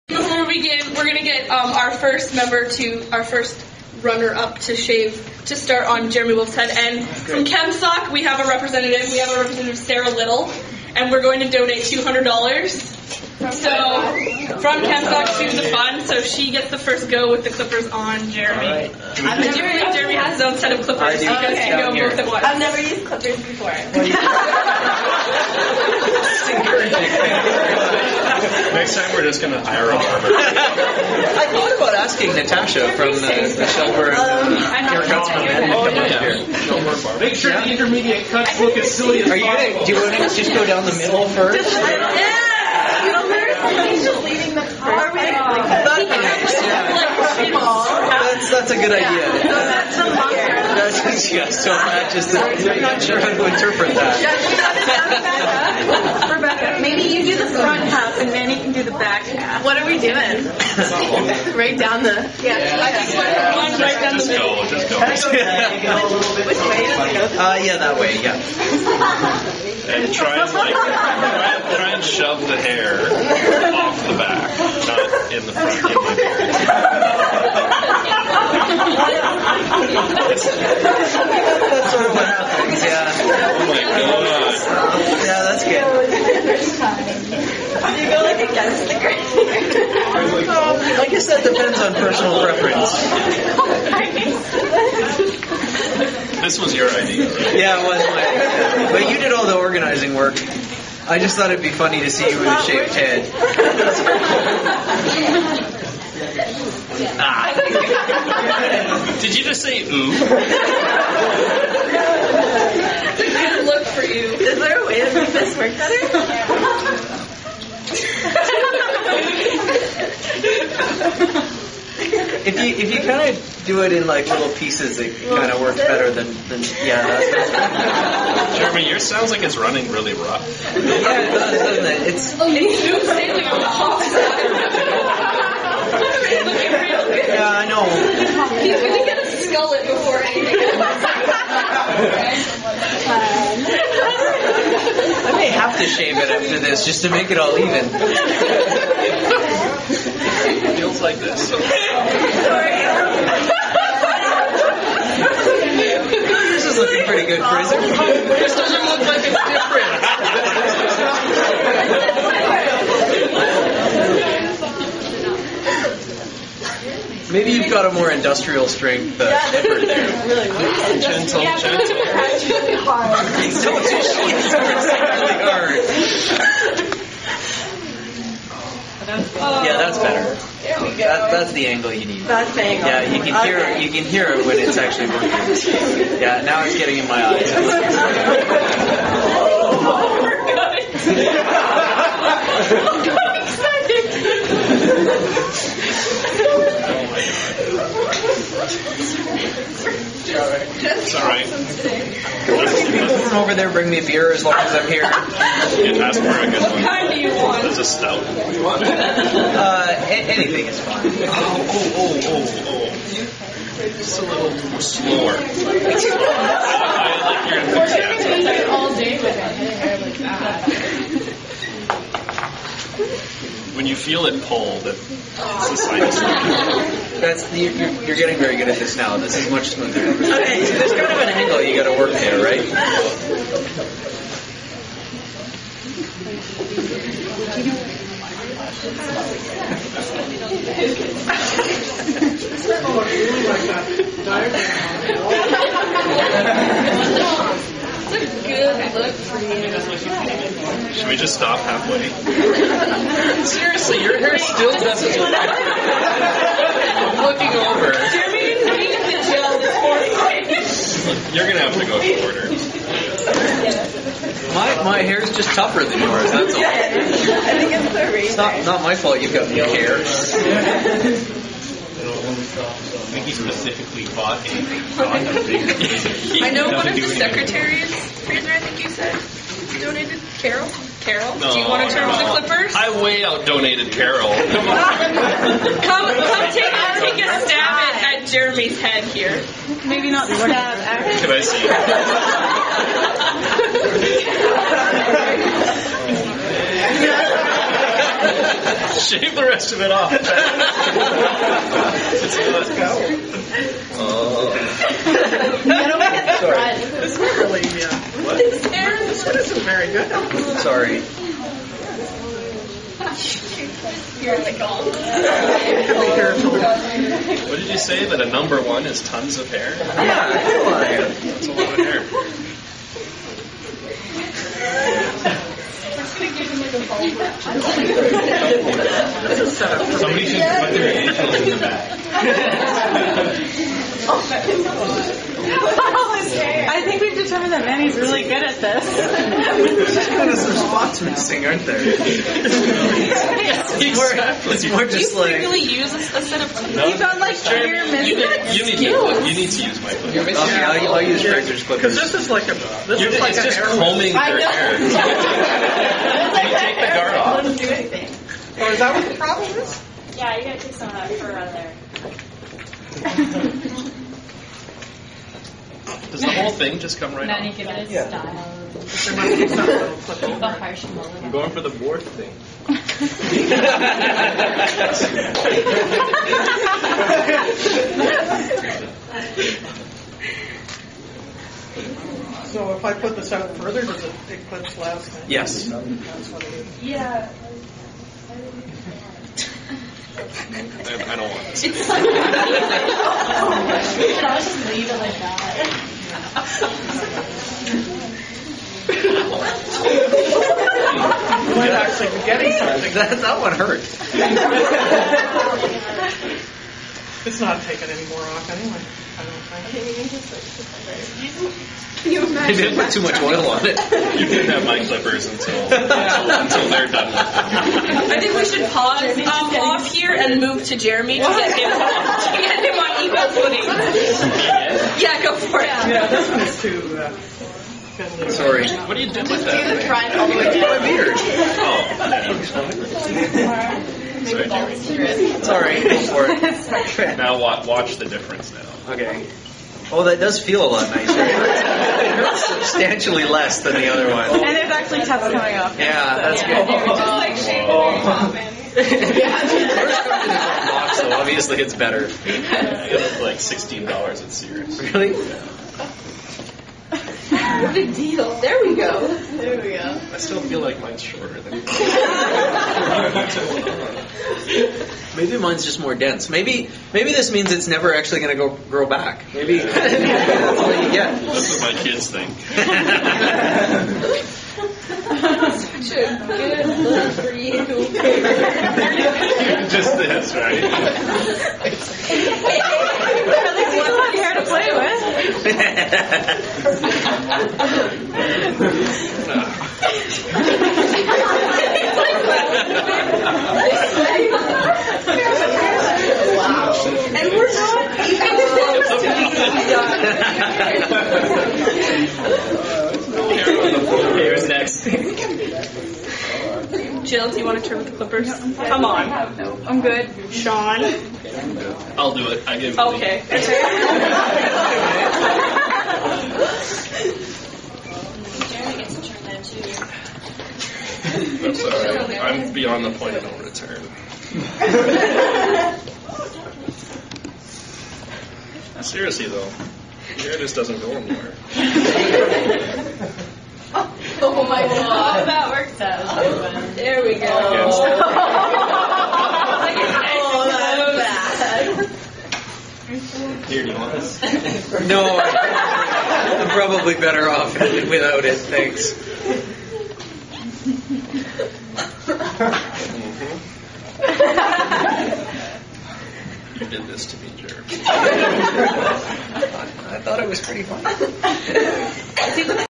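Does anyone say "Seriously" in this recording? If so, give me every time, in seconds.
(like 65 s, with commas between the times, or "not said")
253 s, 528 s.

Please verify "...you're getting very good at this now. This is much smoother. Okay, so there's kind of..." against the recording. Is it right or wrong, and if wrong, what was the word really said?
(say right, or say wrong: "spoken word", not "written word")
right.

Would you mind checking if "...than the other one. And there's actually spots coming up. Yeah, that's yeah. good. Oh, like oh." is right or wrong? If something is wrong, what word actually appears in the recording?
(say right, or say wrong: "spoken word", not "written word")
wrong: "tests", not "spots".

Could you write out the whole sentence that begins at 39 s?
Gonna, do you want to just go down the middle first?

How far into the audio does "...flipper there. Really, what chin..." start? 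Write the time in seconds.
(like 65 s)
169 s.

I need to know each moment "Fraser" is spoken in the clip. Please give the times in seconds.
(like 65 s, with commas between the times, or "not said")
278 s, 351 s.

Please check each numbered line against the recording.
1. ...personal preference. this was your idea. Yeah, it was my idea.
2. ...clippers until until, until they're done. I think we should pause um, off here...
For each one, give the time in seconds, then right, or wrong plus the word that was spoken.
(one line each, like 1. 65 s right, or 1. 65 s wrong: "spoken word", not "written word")
1. 91 s right
2. 414 s right.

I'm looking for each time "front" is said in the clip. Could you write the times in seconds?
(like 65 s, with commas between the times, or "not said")
57 s, 75 s.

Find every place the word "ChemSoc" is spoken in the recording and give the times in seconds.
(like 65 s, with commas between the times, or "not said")
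7 s, 14 s.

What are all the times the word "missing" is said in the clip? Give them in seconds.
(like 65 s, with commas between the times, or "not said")
341 s, 347 s.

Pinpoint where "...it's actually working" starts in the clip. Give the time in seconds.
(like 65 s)
184 s.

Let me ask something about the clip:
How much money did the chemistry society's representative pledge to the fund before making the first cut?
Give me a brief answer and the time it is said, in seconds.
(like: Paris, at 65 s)
$200, at 11 s.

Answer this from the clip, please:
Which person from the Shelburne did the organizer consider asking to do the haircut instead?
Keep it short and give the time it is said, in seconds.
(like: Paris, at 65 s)
Natasha, at 32 s.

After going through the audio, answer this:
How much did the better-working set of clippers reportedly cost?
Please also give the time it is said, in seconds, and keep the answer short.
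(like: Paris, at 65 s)
$16, at 453 s.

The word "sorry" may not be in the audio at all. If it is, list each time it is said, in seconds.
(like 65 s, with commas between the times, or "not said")
306 s, 310 s, 428 s, 434 s, 521 s.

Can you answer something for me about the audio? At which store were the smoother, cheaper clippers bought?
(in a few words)
Sears.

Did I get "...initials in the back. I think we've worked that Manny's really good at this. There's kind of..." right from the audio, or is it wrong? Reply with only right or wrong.
wrong.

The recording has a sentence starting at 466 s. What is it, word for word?
Maybe maybe this means it's never actually going to go grow back.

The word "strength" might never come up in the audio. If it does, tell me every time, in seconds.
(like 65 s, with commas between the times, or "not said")
168 s.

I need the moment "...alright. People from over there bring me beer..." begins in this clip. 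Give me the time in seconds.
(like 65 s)
201 s.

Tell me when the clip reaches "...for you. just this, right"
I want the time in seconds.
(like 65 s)
477 s.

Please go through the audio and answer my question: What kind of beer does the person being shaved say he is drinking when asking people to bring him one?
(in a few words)
stout.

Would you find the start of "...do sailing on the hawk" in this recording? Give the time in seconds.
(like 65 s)
132 s.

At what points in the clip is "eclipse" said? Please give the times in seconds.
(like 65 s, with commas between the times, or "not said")
384 s.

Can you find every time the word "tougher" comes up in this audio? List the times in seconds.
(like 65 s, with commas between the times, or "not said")
265 s.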